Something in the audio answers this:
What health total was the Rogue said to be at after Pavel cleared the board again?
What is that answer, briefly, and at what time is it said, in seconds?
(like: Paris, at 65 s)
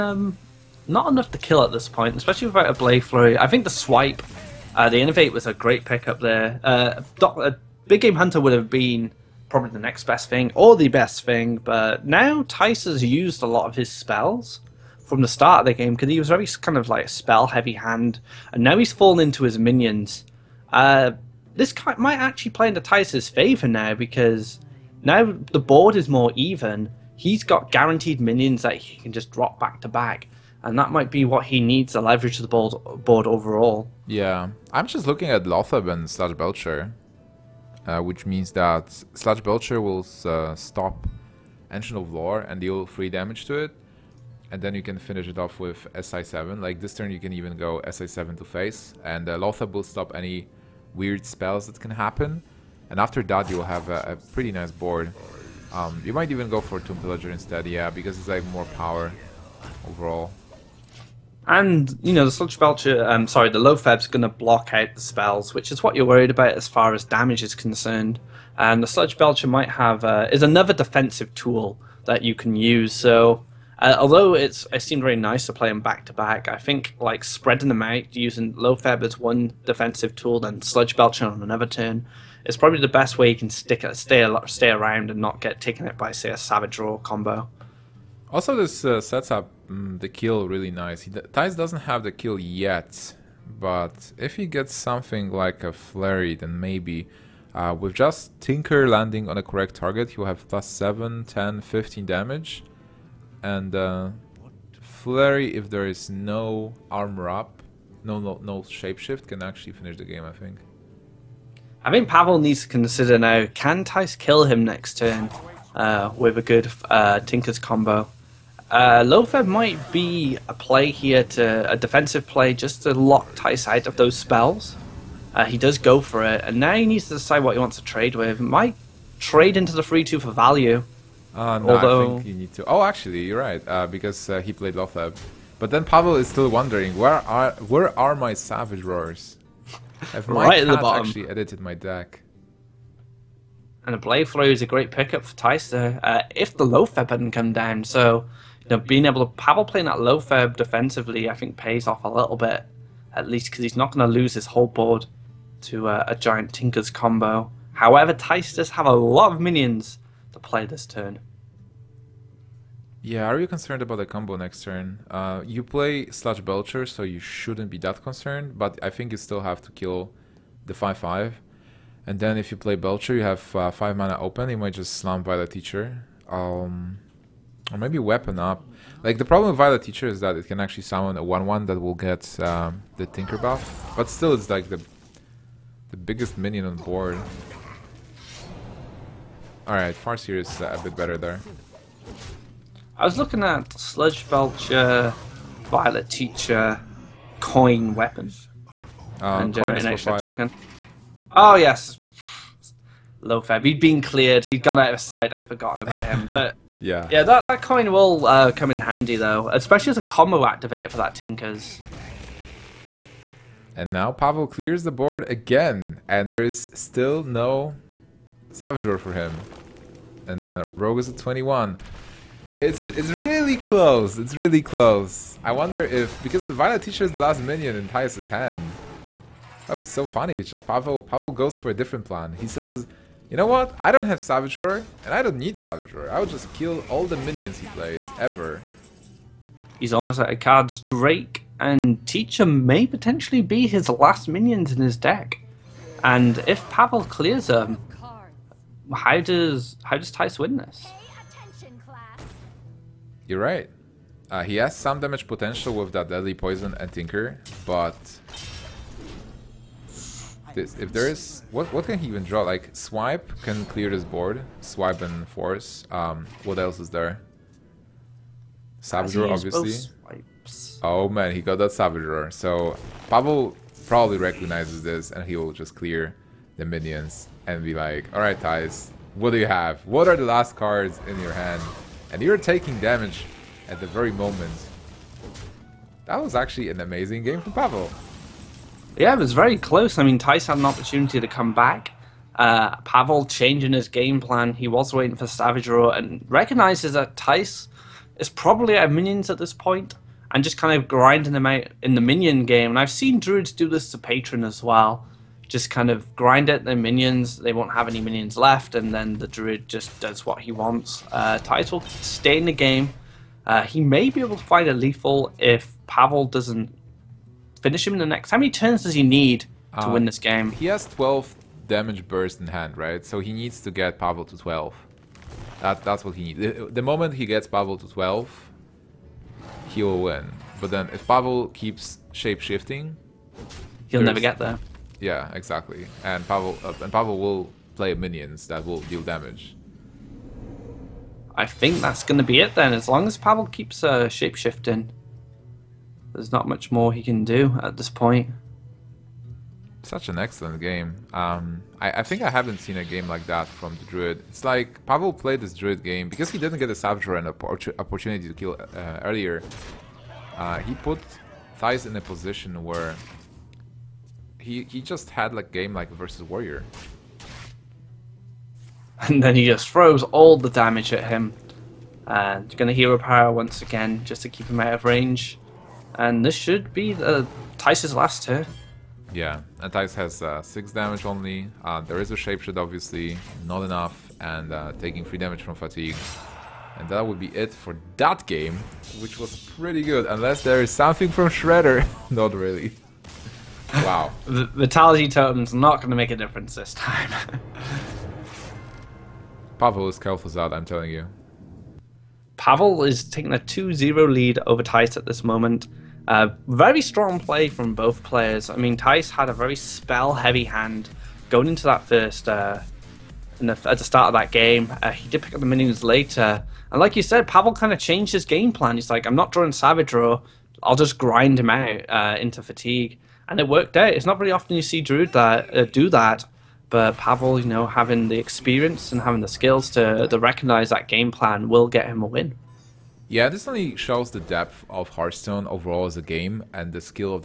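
21, at 221 s.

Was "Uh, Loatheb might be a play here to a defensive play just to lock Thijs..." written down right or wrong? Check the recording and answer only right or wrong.
right.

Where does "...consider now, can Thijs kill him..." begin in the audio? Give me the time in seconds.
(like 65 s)
112 s.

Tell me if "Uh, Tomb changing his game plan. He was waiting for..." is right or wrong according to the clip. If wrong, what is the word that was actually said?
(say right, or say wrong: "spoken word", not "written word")
wrong: "Pavel", not "Tomb".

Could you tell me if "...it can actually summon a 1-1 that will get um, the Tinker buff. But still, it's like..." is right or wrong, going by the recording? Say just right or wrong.
right.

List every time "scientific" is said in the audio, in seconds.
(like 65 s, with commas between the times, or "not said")
not said.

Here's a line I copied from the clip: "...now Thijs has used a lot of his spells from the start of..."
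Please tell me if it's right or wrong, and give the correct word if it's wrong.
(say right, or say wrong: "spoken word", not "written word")
right.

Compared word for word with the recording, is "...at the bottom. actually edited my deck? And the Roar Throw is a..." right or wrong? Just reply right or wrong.
wrong.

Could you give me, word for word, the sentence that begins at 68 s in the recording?
And the sludge belcher might have uh, is another defensive tool that you can use.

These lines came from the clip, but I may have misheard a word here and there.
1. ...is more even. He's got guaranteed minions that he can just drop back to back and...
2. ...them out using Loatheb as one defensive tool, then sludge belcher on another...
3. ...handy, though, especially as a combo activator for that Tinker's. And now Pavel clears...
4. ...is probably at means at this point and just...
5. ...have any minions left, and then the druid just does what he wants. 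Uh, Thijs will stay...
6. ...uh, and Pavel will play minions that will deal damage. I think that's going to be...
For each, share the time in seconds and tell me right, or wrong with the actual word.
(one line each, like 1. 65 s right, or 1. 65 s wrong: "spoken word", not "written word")
1. 25 s right
2. 77 s right
3. 208 s right
4. 298 s wrong: "minions", not "means"
5. 307 s right
6. 336 s right.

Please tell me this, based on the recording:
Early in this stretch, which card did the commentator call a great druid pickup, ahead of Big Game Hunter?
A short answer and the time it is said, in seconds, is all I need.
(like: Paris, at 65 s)
Innervate, at 4 s.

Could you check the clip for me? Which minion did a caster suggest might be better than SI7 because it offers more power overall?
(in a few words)
Tomb Pillager.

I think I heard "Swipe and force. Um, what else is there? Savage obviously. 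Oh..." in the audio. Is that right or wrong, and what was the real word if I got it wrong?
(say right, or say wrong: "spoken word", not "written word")
right.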